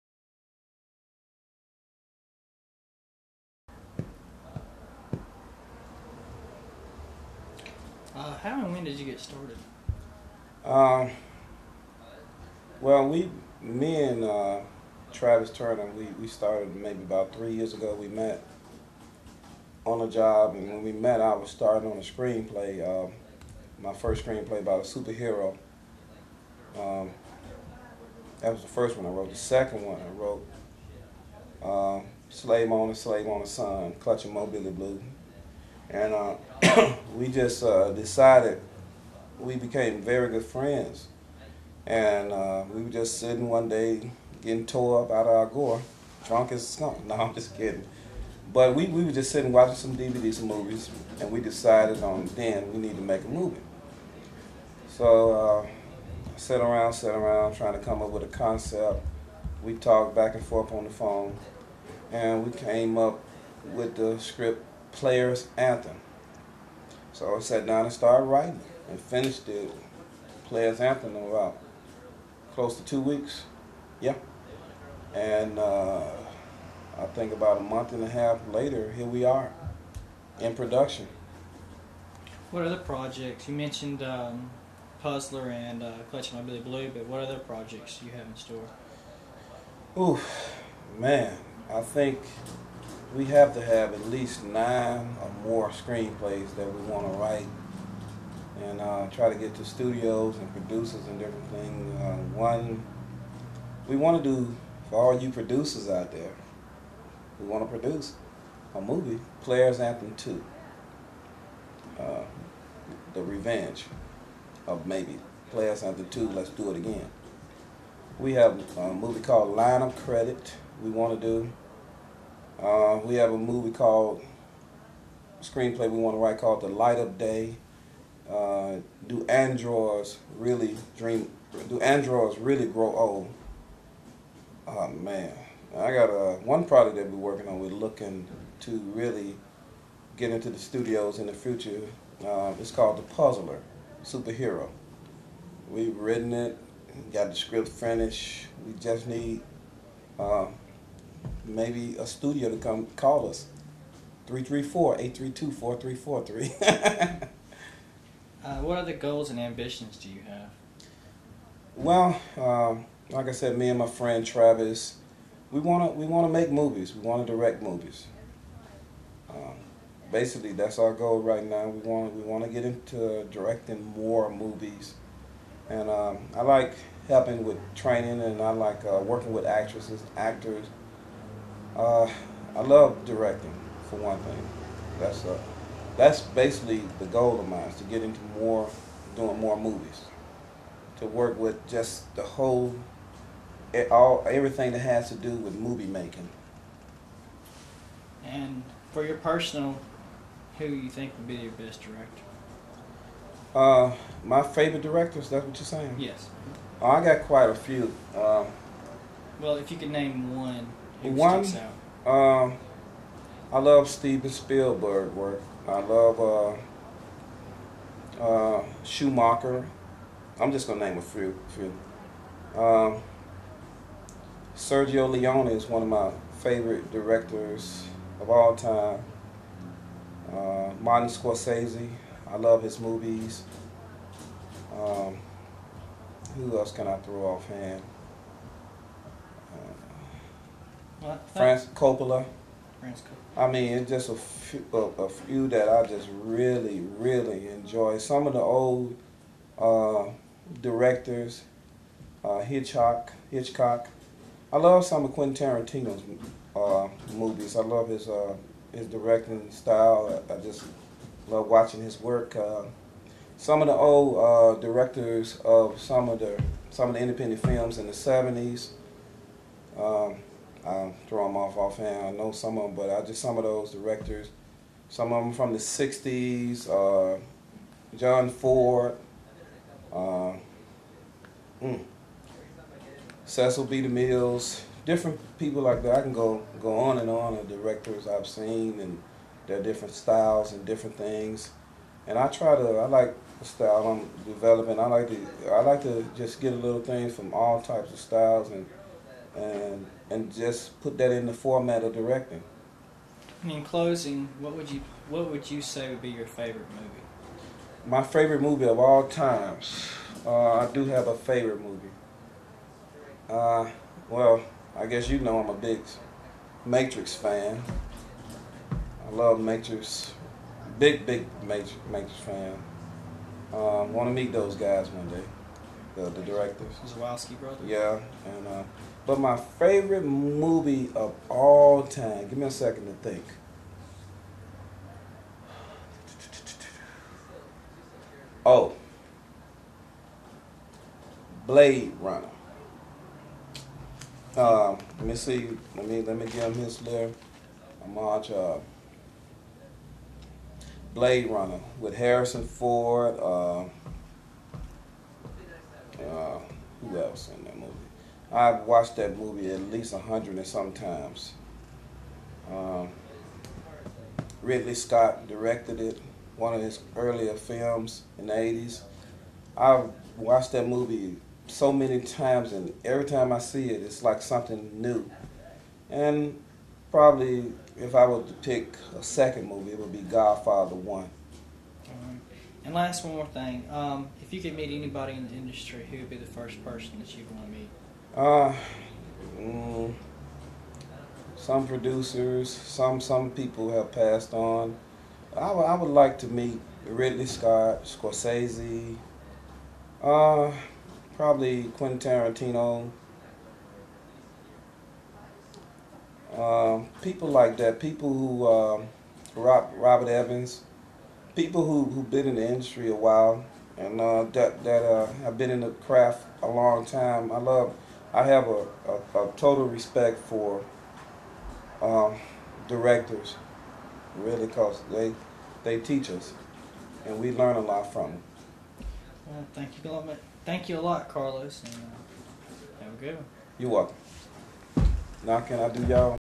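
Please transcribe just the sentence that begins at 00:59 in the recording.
We talked back and forth on the phone, and we came up with the script Players Anthem.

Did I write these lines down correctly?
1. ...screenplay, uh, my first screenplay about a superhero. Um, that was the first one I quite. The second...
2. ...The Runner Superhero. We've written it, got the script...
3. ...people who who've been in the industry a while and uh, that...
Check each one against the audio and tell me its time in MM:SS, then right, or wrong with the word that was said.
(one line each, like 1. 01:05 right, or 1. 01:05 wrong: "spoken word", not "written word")
1. 00:22 wrong: "wrote", not "quite"
2. 02:22 wrong: "Puzzler", not "Runner"
3. 06:51 right.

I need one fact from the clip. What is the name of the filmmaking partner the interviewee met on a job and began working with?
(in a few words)
Travis Turner.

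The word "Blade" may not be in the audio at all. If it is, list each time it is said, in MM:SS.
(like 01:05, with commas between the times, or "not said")
05:41, 05:50.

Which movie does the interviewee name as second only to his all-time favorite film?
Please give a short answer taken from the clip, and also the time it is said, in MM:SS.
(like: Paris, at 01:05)
Godfather 1, at 06:19.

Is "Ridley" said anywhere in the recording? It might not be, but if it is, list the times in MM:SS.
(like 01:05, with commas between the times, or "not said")
06:04, 06:36.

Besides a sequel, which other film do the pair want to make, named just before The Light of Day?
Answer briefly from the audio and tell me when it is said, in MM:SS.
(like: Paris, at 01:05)
Line of Credit, at 01:59.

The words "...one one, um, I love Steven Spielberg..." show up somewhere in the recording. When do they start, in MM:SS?
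03:30.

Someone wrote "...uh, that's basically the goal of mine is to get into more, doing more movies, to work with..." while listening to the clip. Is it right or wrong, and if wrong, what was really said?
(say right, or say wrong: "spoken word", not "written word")
right.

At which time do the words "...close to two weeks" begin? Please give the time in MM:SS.
01:12.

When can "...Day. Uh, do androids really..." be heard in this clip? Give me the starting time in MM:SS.
02:07.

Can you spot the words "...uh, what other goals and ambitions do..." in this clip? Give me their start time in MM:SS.
02:38.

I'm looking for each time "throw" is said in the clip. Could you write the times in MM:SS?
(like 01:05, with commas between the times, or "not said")
03:56, 04:31.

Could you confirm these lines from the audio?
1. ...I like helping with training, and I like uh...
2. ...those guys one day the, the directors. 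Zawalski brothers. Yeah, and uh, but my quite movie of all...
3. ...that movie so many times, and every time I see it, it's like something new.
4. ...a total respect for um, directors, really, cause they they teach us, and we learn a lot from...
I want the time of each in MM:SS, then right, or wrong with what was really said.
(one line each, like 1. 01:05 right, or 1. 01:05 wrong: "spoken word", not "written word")
1. 02:56 right
2. 05:24 wrong: "favorite", not "quite"
3. 06:10 right
4. 06:59 right.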